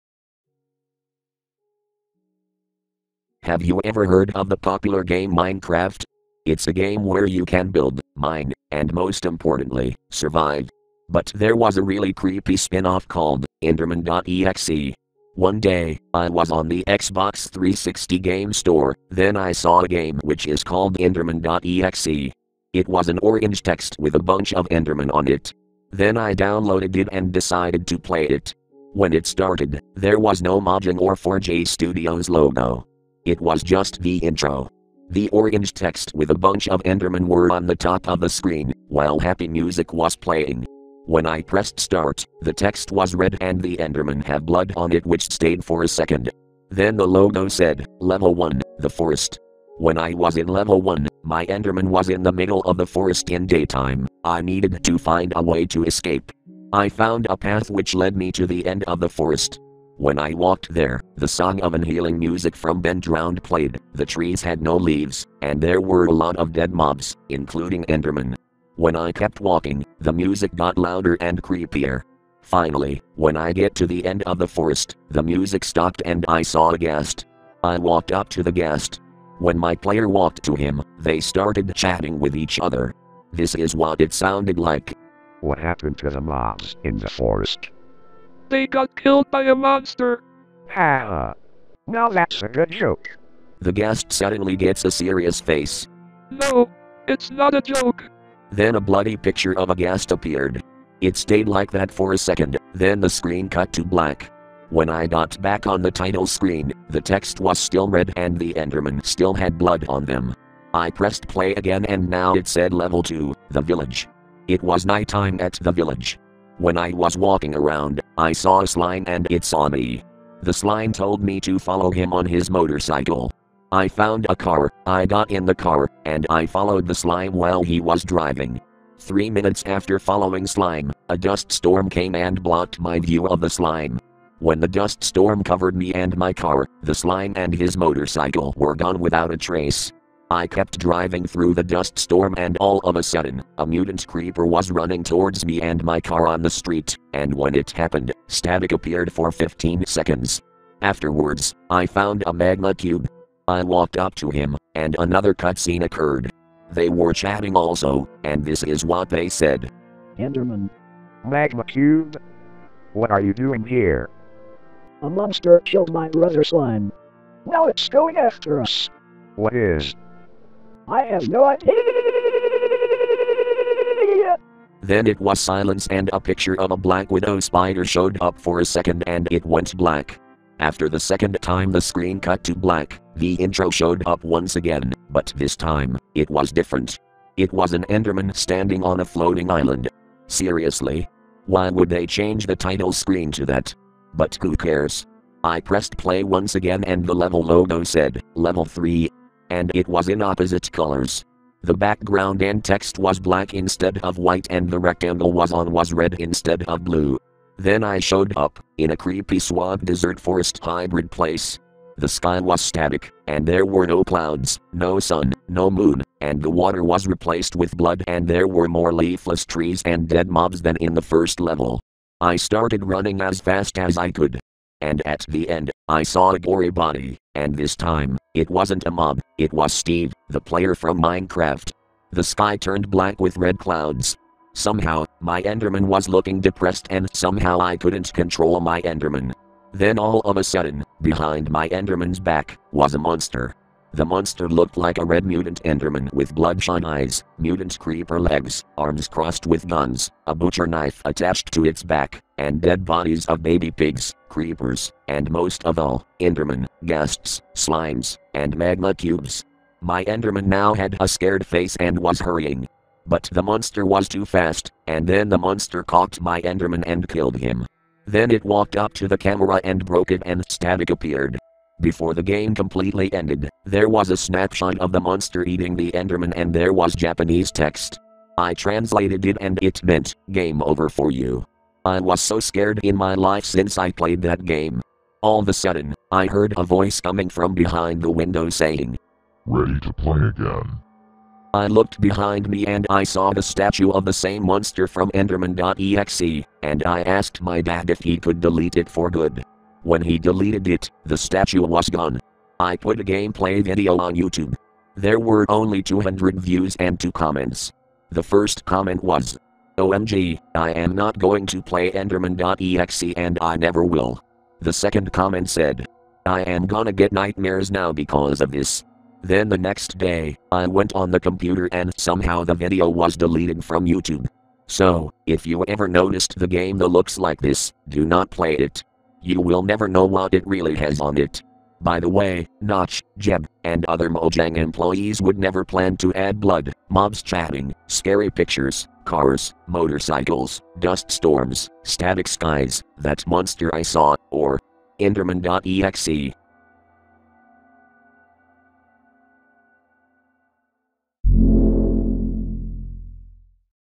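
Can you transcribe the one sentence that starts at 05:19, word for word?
Then the next day, I went on the computer and somehow the video was deleted from YouTube.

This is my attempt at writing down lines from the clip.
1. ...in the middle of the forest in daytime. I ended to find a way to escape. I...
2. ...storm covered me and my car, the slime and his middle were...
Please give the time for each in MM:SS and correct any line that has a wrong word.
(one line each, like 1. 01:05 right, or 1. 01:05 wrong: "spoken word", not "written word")
1. 00:52 wrong: "needed", not "ended"
2. 02:15 wrong: "motorcycle", not "middle".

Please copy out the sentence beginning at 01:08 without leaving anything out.
When I kept walking, the music got louder and creepier.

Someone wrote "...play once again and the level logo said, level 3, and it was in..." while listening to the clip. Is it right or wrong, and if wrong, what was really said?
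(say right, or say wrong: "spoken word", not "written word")
right.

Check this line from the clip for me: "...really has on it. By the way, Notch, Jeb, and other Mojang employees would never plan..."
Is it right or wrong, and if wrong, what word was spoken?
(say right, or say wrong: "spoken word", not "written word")
right.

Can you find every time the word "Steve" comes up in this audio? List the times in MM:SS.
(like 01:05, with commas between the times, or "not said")
03:49.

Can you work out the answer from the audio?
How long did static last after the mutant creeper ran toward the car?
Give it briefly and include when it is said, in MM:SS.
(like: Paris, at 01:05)
15 seconds, at 02:29.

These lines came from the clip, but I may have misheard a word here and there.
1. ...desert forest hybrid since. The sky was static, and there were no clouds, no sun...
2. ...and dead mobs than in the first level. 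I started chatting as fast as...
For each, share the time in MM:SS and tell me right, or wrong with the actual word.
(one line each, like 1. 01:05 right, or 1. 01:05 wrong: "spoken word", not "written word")
1. 03:29 wrong: "place", not "since"
2. 03:39 wrong: "running", not "chatting".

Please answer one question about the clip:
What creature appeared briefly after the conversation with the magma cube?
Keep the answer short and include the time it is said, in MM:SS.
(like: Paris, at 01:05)
Black widow spider, at 02:56.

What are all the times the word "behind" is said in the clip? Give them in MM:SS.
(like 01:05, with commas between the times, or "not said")
04:01, 04:47, 04:51.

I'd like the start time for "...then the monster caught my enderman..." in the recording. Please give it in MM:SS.
04:25.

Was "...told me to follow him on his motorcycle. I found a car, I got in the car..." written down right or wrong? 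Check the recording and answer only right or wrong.
right.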